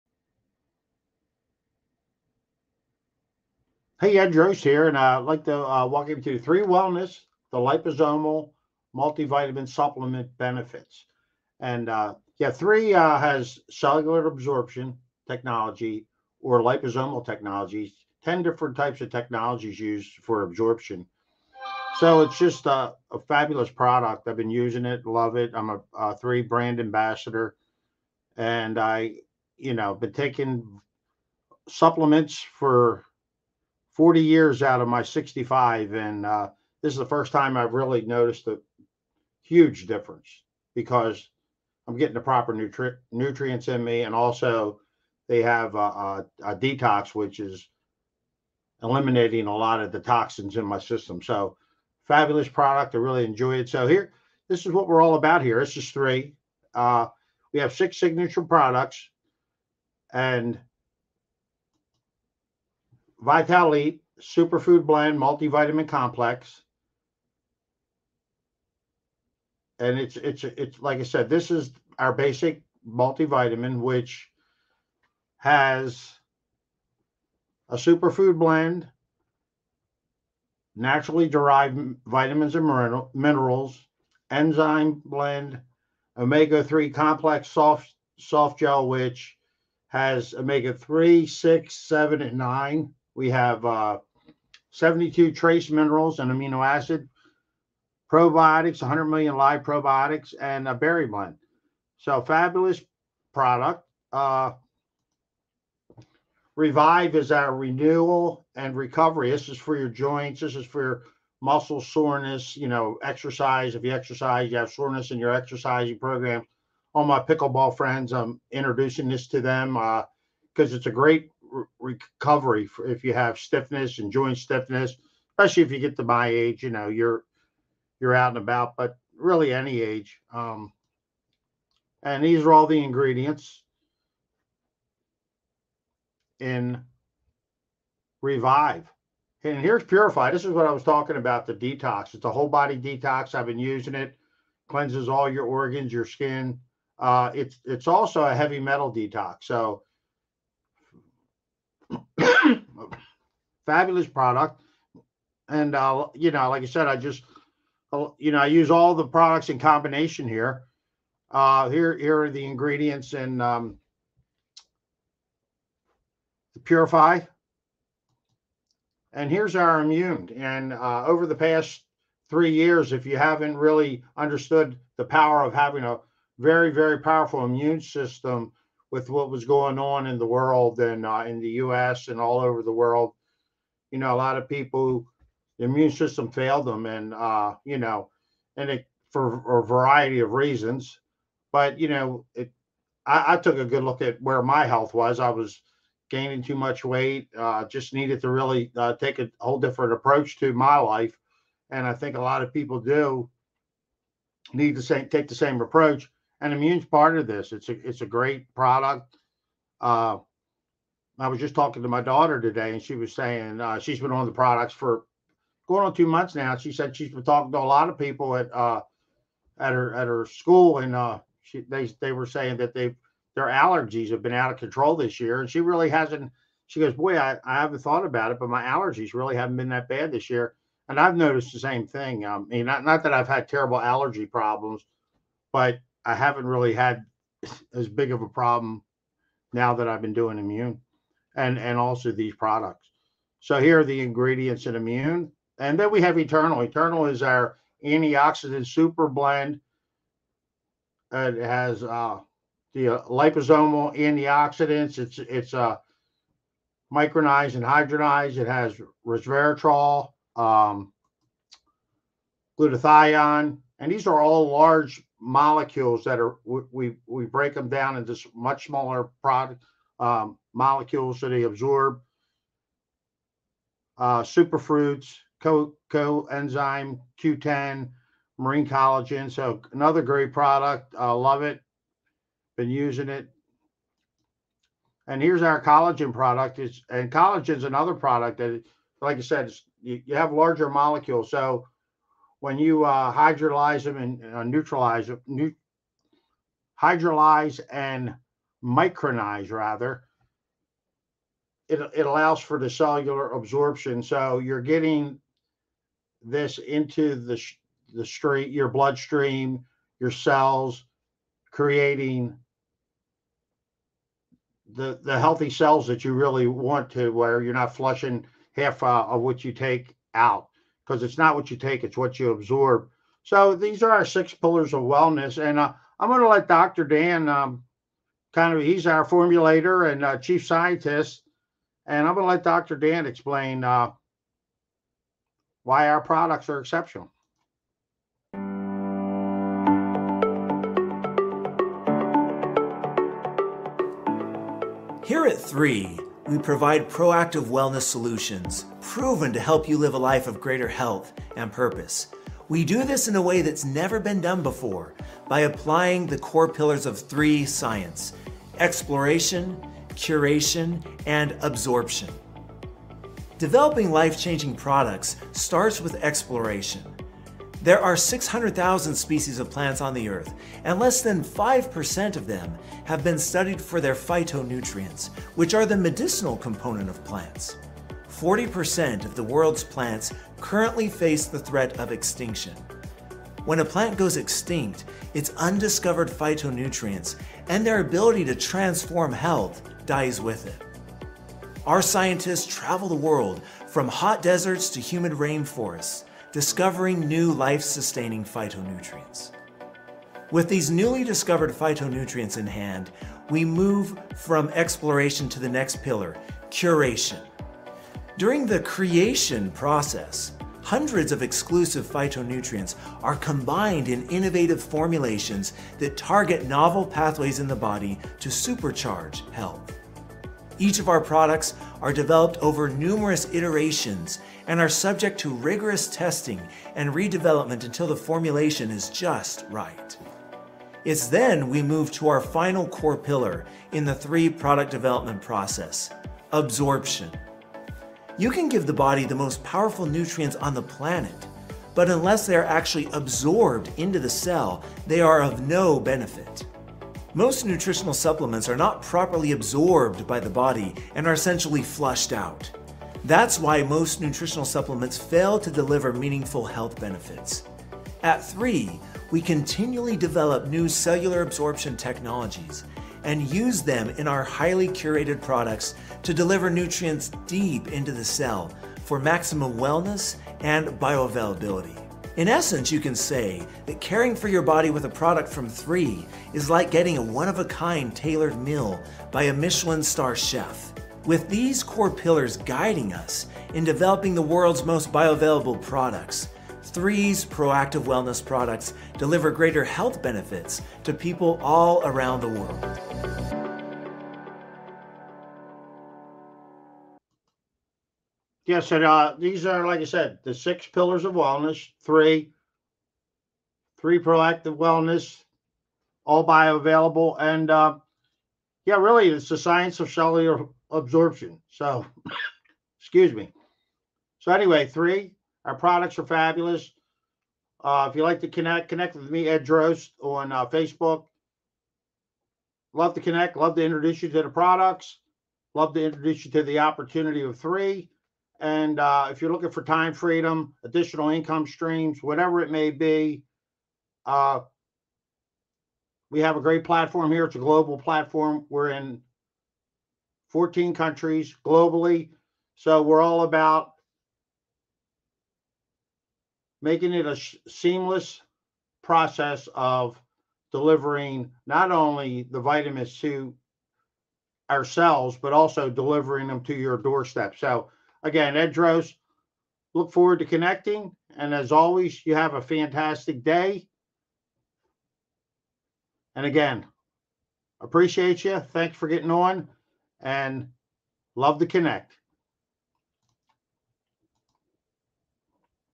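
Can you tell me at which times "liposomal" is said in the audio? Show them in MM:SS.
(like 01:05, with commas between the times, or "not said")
00:07, 00:16, 04:13.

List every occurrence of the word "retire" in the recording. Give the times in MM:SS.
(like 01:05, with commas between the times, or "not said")
not said.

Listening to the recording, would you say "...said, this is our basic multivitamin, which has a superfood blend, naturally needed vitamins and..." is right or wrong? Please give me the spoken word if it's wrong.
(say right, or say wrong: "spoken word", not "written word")
wrong: "derived", not "needed".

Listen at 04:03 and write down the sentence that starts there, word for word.
So here are the ingredients in immune.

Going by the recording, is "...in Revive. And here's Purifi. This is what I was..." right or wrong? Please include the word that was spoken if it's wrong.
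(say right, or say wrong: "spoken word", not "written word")
right.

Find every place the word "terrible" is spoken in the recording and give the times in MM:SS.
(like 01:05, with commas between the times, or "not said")
03:53.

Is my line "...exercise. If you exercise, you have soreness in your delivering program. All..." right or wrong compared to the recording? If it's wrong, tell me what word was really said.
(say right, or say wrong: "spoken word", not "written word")
wrong: "exercising", not "delivering".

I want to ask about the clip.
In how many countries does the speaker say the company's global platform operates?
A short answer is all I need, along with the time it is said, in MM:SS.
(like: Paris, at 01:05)
14, at 09:00.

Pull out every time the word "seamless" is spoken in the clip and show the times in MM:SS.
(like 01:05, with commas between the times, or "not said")
09:07.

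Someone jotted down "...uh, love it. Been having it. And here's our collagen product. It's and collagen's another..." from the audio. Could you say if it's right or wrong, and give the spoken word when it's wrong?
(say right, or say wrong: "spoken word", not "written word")
wrong: "using", not "having".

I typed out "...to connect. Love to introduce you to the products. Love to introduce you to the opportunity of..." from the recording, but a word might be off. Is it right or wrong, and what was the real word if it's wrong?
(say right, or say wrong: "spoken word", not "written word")
right.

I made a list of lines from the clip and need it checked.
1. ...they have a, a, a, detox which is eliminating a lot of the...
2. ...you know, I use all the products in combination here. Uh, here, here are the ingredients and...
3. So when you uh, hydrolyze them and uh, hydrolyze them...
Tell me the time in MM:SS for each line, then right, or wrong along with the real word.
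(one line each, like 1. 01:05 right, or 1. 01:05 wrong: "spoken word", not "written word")
1. 00:45 right
2. 02:38 right
3. 04:51 wrong: "neutralize", not "hydrolyze".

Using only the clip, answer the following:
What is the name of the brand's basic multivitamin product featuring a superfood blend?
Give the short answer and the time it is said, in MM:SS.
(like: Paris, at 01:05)
Vitalite, at 01:03.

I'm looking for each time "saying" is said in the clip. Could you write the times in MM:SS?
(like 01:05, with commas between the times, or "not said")
03:33, 03:42.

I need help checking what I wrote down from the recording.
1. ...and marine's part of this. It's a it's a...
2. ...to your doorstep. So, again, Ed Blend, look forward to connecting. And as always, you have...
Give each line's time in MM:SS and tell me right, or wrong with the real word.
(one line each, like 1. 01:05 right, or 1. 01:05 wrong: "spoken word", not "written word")
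1. 03:26 wrong: "immune", not "marine"
2. 09:16 wrong: "Drost", not "Blend".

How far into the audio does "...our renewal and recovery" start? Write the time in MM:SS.
01:47.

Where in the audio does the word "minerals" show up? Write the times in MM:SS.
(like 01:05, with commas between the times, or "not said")
01:23, 01:35.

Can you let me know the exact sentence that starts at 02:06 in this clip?
You know, you're you're out and about, but really any age.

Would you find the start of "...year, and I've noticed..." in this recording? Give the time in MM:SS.
03:50.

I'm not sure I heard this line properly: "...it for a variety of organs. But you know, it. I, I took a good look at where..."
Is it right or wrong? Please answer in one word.
wrong.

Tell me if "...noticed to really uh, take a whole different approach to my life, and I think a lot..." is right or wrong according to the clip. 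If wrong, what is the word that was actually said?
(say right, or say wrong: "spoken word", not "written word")
wrong: "needed", not "noticed".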